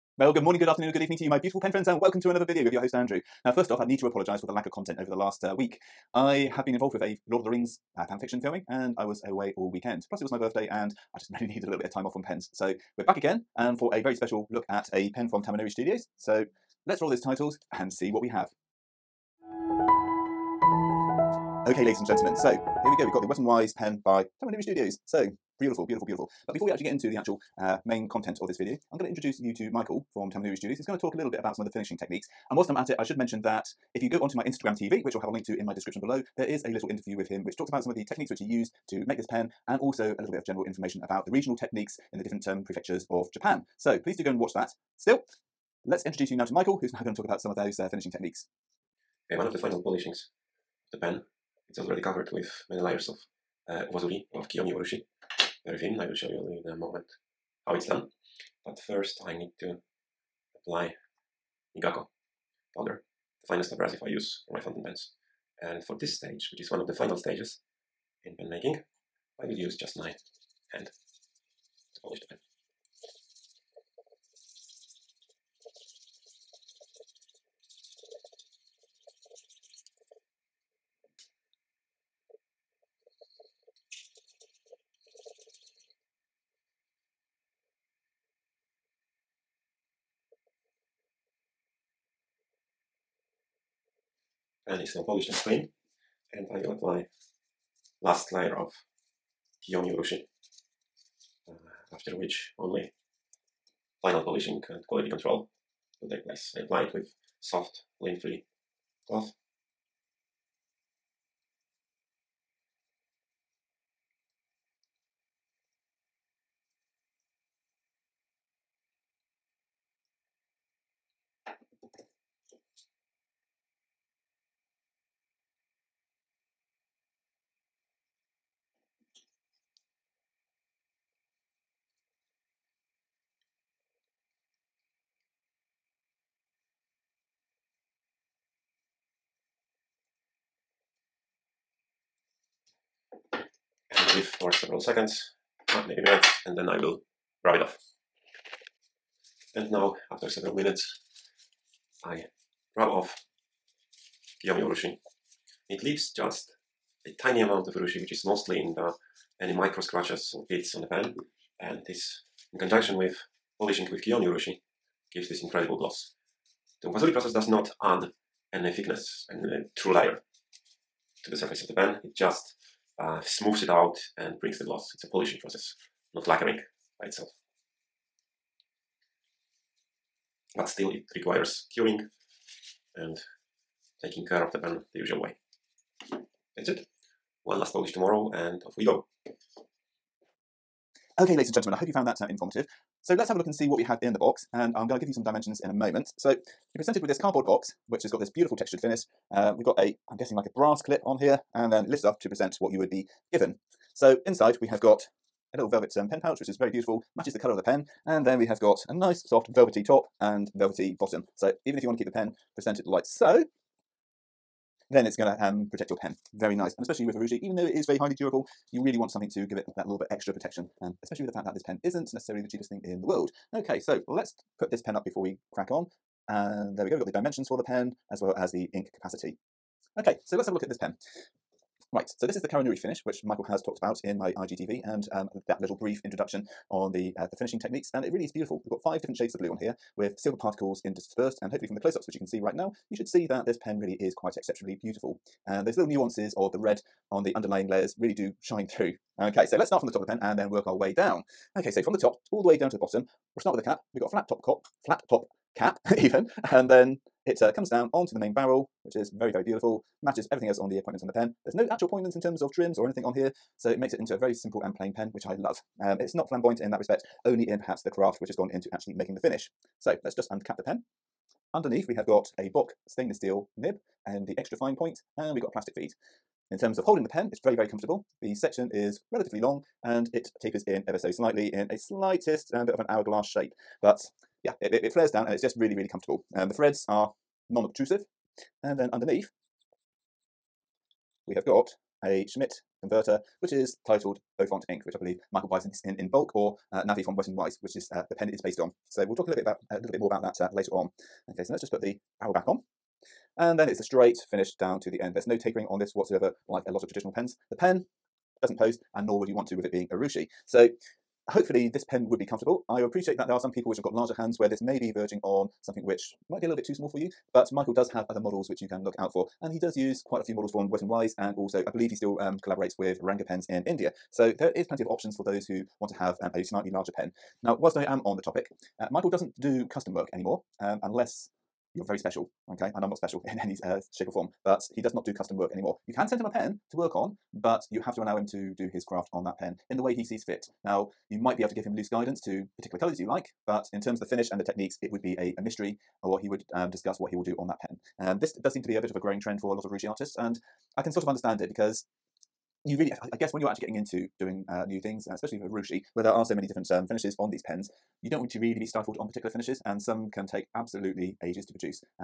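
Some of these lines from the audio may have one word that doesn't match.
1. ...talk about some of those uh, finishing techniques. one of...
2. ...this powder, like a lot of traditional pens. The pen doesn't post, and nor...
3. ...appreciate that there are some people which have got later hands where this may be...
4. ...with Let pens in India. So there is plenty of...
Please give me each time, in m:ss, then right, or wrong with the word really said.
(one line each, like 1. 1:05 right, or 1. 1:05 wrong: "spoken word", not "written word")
1. 0:47 right
2. 5:05 wrong: "whatsoever", not "powder"
3. 5:12 wrong: "larger", not "later"
4. 5:22 wrong: "Ranga", not "Let".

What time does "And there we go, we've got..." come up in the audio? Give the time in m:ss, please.
3:46.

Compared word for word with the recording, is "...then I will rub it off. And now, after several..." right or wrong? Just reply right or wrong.
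right.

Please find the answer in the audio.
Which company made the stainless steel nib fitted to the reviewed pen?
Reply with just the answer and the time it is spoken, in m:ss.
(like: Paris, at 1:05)
Bock, at 4:32.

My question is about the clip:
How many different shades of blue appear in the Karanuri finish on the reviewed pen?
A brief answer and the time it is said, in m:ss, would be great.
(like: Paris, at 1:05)
5, at 3:58.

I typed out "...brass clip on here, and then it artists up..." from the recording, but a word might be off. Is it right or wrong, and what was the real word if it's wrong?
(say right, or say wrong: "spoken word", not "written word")
wrong: "lists", not "artists".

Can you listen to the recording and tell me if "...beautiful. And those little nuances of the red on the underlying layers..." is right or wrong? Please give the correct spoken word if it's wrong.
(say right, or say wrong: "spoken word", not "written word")
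right.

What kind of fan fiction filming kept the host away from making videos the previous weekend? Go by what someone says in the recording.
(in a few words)
Lord of the Rings.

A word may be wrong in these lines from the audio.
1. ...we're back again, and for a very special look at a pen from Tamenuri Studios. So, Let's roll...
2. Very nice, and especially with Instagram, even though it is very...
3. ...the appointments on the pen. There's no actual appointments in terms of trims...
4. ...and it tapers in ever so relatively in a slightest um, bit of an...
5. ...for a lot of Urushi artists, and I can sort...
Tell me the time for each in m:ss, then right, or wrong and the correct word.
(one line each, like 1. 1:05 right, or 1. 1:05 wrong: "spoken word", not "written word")
1. 0:12 right
2. 3:36 wrong: "Urushi", not "Instagram"
3. 4:20 right
4. 4:39 wrong: "slightly", not "relatively"
5. 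5:49 right.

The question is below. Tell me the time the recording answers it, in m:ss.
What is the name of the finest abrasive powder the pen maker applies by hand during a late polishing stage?
1:01.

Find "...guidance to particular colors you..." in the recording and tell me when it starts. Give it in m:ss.
5:41.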